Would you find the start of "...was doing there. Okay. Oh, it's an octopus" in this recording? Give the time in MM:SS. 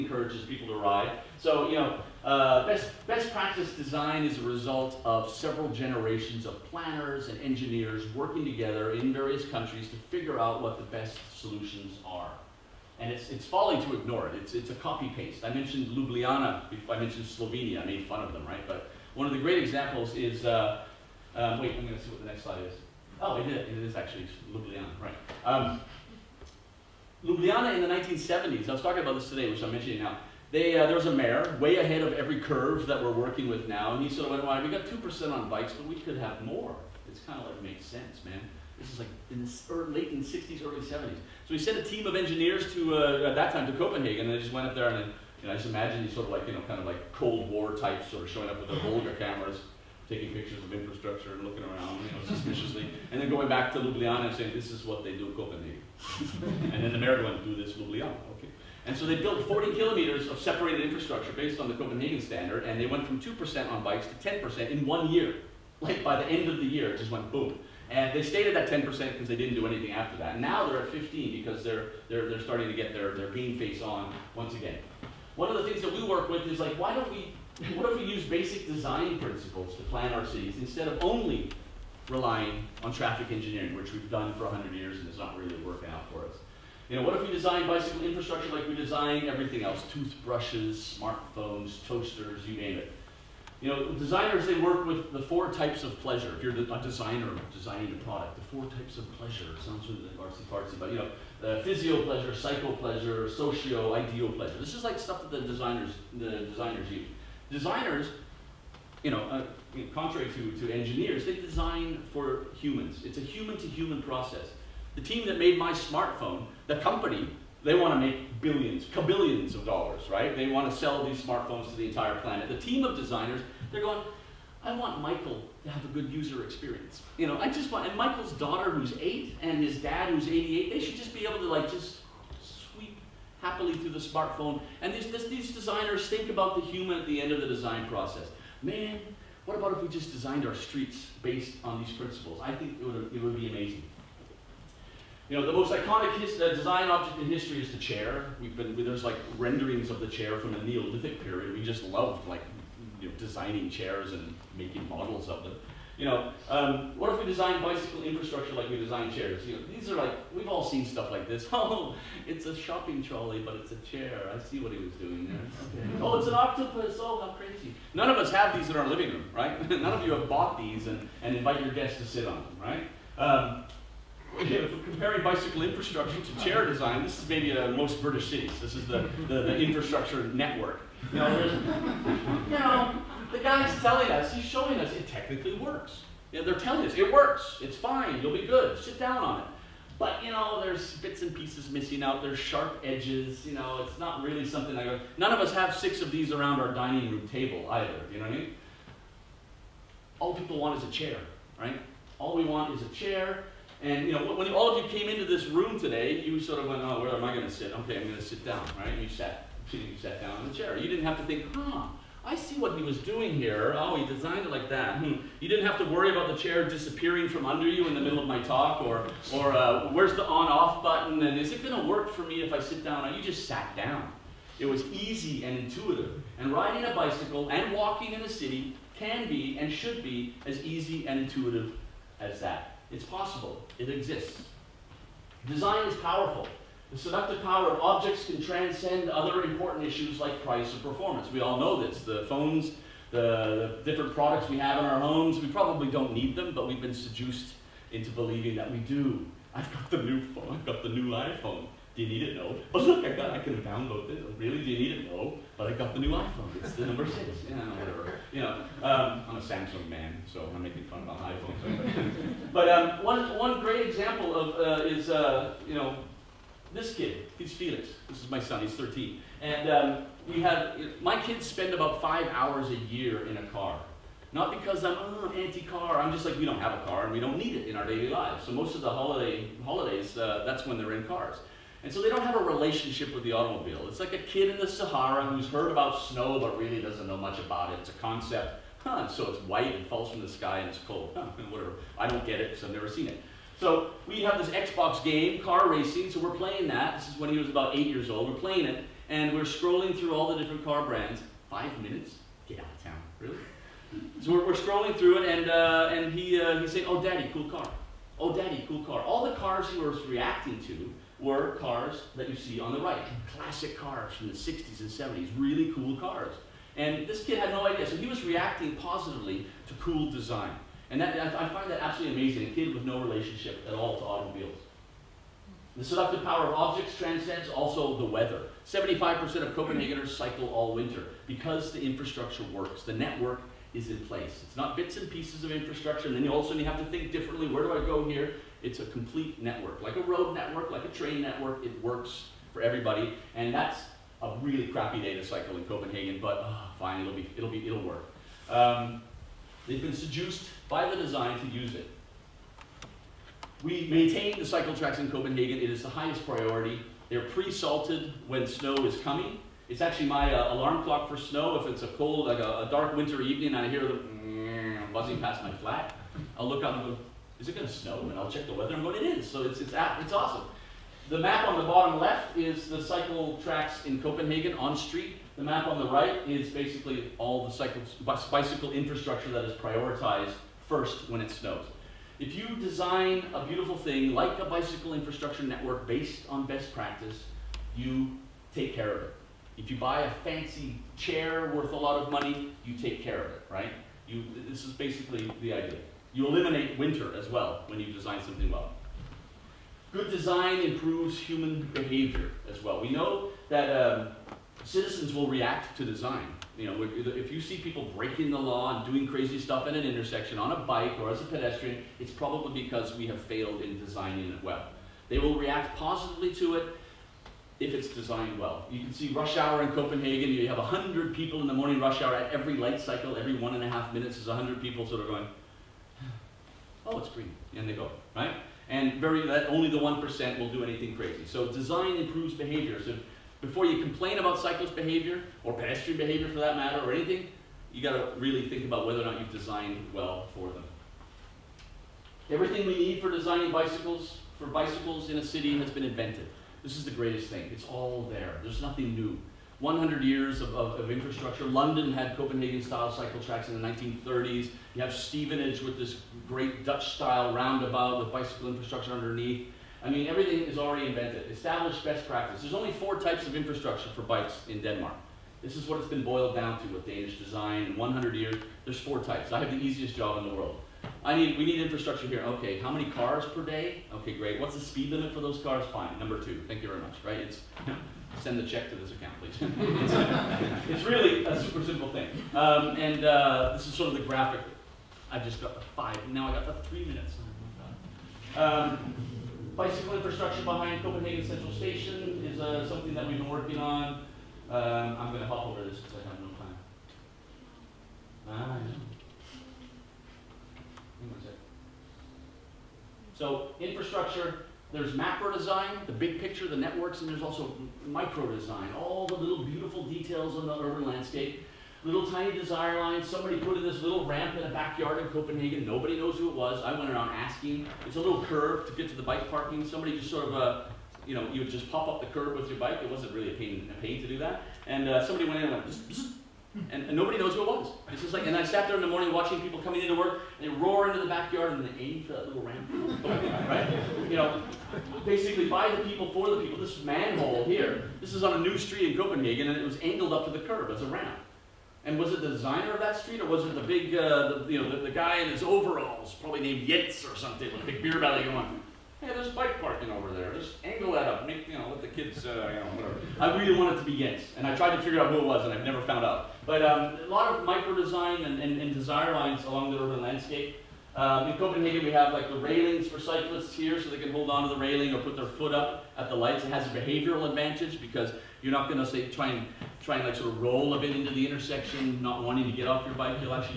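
02:44.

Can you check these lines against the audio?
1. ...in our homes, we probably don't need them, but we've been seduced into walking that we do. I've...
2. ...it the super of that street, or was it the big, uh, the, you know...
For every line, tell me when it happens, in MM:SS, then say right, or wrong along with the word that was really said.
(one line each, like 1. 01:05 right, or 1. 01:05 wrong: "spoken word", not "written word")
1. 04:04 wrong: "believing", not "walking"
2. 09:02 wrong: "designer", not "super".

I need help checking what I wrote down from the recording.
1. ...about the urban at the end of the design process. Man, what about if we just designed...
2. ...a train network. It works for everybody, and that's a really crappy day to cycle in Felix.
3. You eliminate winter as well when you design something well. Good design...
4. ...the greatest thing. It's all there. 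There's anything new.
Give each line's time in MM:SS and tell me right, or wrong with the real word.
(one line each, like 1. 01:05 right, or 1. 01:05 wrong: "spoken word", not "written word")
1. 02:16 wrong: "human", not "urban"
2. 05:40 wrong: "Copenhagen", not "Felix"
3. 06:36 right
4. 07:26 wrong: "nothing", not "anything".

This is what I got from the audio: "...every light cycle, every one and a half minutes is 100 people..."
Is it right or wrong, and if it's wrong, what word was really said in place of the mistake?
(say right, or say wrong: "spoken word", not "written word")
right.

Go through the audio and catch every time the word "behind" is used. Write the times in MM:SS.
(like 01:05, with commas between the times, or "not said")
08:10.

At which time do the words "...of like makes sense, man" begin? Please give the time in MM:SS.
00:37.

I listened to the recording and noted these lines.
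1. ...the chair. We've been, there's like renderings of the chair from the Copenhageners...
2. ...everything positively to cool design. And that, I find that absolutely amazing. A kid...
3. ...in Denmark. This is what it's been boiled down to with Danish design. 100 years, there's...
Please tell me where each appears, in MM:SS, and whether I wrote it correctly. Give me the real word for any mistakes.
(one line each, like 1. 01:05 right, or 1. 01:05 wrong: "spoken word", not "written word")
1. 02:27 wrong: "Neolithic", not "Copenhageners"
2. 05:18 wrong: "reacting", not "everything"
3. 07:44 right.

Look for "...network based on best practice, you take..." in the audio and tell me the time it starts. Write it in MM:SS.
06:25.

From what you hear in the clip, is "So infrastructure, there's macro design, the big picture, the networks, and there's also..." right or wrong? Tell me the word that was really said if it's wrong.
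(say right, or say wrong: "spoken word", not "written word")
right.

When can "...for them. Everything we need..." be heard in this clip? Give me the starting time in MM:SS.
07:20.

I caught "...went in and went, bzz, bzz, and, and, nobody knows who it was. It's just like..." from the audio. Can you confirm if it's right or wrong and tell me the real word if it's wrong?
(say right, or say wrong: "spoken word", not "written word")
right.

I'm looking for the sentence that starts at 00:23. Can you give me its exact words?
Oh, it is, it is actually Ljubljana, right.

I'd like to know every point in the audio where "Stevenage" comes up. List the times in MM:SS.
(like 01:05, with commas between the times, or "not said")
07:34.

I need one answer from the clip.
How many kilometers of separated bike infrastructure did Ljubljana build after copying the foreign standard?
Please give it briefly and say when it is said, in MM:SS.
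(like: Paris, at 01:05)
40, at 00:59.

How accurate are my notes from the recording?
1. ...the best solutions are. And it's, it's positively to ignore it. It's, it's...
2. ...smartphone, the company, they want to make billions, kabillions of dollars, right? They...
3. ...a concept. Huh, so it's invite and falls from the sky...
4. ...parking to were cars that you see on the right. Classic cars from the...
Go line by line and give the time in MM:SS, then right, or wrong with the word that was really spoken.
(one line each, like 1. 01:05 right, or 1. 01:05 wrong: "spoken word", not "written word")
1. 00:10 wrong: "folly", not "positively"
2. 01:55 right
3. 04:47 wrong: "white", not "invite"
4. 05:10 wrong: "reacting", not "parking".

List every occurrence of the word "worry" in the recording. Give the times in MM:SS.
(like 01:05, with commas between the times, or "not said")
03:35.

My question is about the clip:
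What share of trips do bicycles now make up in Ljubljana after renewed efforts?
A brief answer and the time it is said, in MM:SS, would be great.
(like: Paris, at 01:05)
15%, at 01:10.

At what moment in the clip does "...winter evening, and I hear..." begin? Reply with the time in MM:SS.
06:02.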